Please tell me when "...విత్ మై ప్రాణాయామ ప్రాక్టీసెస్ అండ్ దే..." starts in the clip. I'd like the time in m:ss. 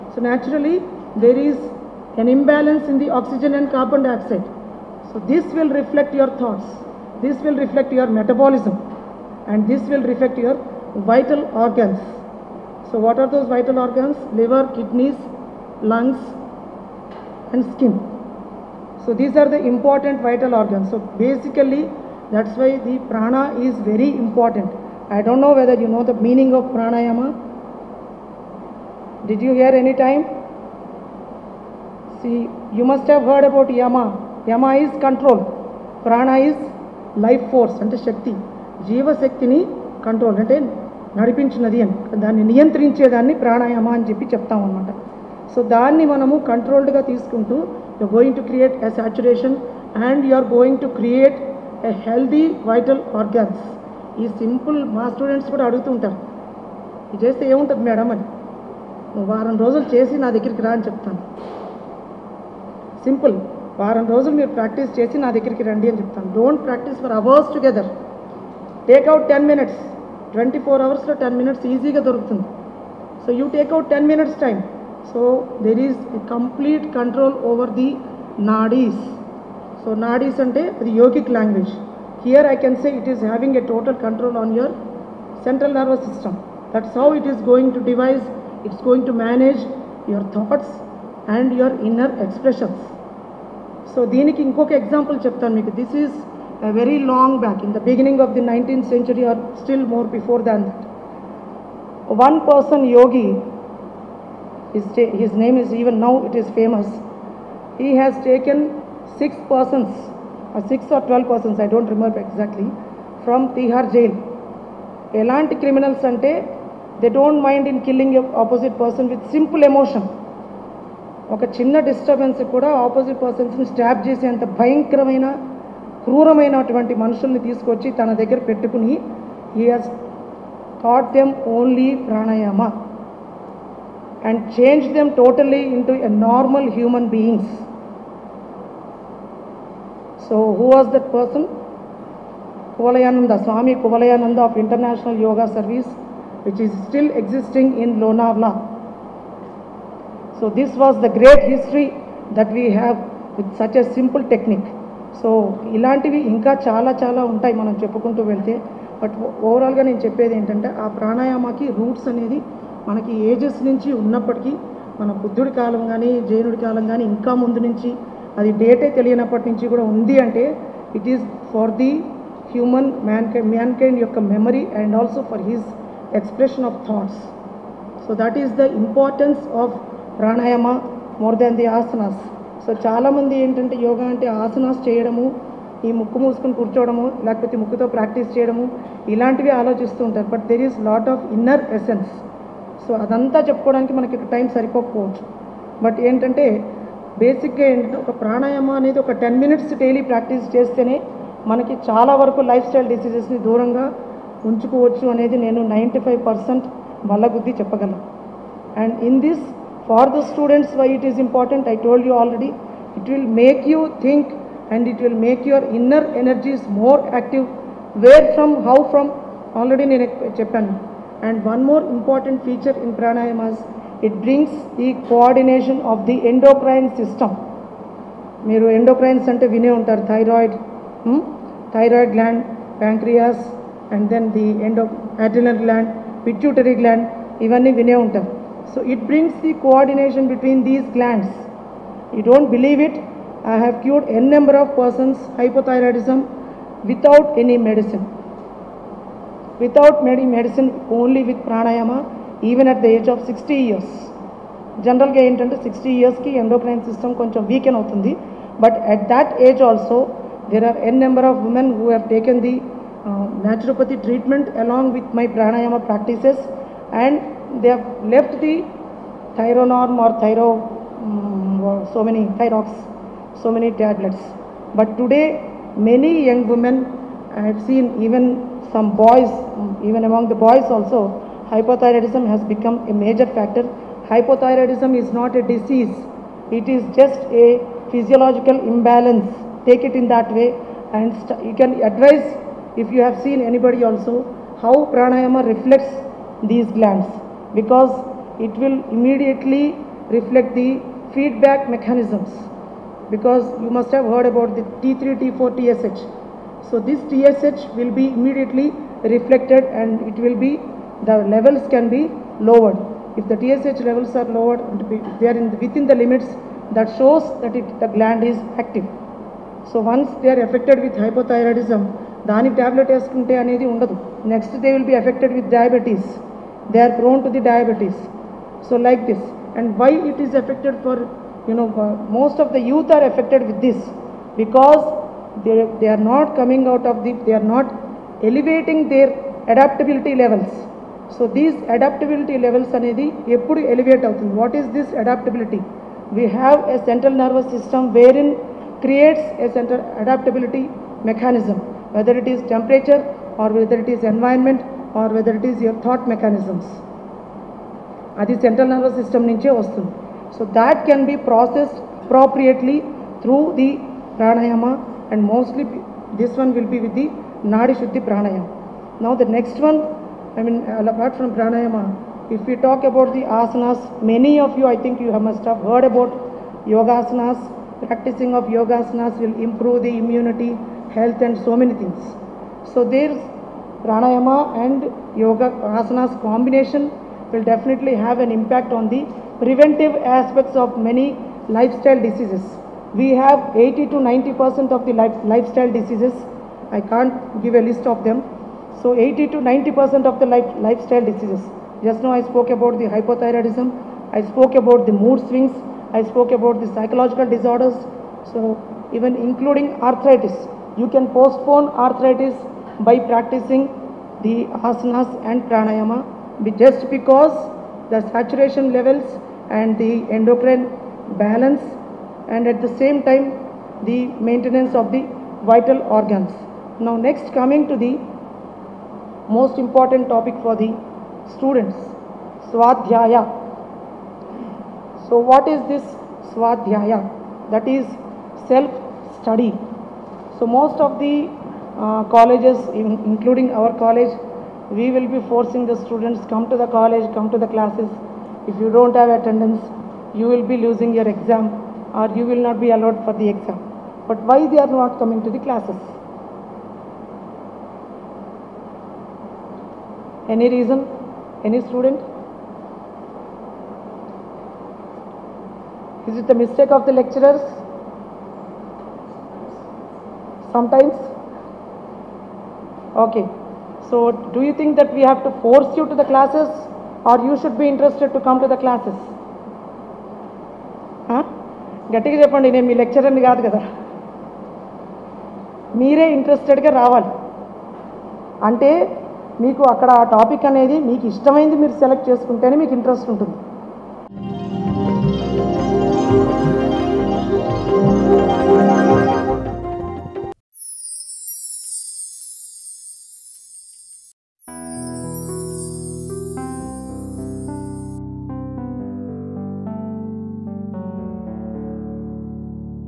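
4:24.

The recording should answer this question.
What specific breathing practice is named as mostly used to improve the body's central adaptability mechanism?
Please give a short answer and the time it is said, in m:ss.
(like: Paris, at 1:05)
Nadi Shuddhi Pranayama, at 6:07.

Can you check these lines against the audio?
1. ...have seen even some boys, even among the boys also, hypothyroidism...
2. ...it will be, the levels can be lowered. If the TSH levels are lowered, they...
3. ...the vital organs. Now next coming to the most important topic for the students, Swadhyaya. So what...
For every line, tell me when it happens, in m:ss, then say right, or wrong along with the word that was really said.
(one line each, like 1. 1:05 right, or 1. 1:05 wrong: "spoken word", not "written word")
1. 4:37 right
2. 5:10 right
3. 7:04 right.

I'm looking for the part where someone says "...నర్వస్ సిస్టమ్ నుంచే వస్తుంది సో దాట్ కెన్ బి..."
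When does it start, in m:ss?
5:58.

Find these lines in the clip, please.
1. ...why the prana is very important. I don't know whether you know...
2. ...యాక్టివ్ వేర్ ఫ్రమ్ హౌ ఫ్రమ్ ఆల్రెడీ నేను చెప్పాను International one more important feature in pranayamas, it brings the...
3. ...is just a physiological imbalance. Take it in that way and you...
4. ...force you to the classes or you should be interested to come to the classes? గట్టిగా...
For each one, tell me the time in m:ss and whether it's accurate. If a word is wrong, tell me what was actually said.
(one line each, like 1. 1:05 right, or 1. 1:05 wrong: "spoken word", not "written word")
1. 0:22 right
2. 3:37 wrong: "And", not "International"
3. 4:46 right
4. 7:55 right.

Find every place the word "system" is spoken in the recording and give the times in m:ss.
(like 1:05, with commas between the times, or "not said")
1:26, 3:47.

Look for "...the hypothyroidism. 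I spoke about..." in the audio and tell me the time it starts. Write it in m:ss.
6:42.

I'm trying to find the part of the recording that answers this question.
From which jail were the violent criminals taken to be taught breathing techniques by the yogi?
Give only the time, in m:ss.
1:53.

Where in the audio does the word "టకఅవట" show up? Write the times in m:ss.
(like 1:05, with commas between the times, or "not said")
1:08, 1:13.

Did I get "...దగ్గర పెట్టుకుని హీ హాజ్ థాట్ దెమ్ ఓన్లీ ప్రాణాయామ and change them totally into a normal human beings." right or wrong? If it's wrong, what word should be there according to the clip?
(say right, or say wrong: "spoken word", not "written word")
right.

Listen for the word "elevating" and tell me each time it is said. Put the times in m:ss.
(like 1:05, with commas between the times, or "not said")
5:38.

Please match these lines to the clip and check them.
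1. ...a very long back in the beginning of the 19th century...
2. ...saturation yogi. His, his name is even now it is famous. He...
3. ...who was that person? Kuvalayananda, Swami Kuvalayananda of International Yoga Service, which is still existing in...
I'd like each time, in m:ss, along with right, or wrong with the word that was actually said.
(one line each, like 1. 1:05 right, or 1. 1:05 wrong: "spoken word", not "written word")
1. 1:36 right
2. 1:42 wrong: "person", not "saturation"
3. 2:20 right.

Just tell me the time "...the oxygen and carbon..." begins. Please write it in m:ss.
0:02.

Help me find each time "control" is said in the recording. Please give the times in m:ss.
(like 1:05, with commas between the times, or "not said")
0:35, 1:16, 1:23.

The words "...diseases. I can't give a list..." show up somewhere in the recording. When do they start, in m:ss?
6:35.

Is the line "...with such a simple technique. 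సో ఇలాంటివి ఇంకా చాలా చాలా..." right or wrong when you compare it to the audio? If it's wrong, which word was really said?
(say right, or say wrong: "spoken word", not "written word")
right.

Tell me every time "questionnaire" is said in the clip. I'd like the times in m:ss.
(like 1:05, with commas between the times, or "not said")
not said.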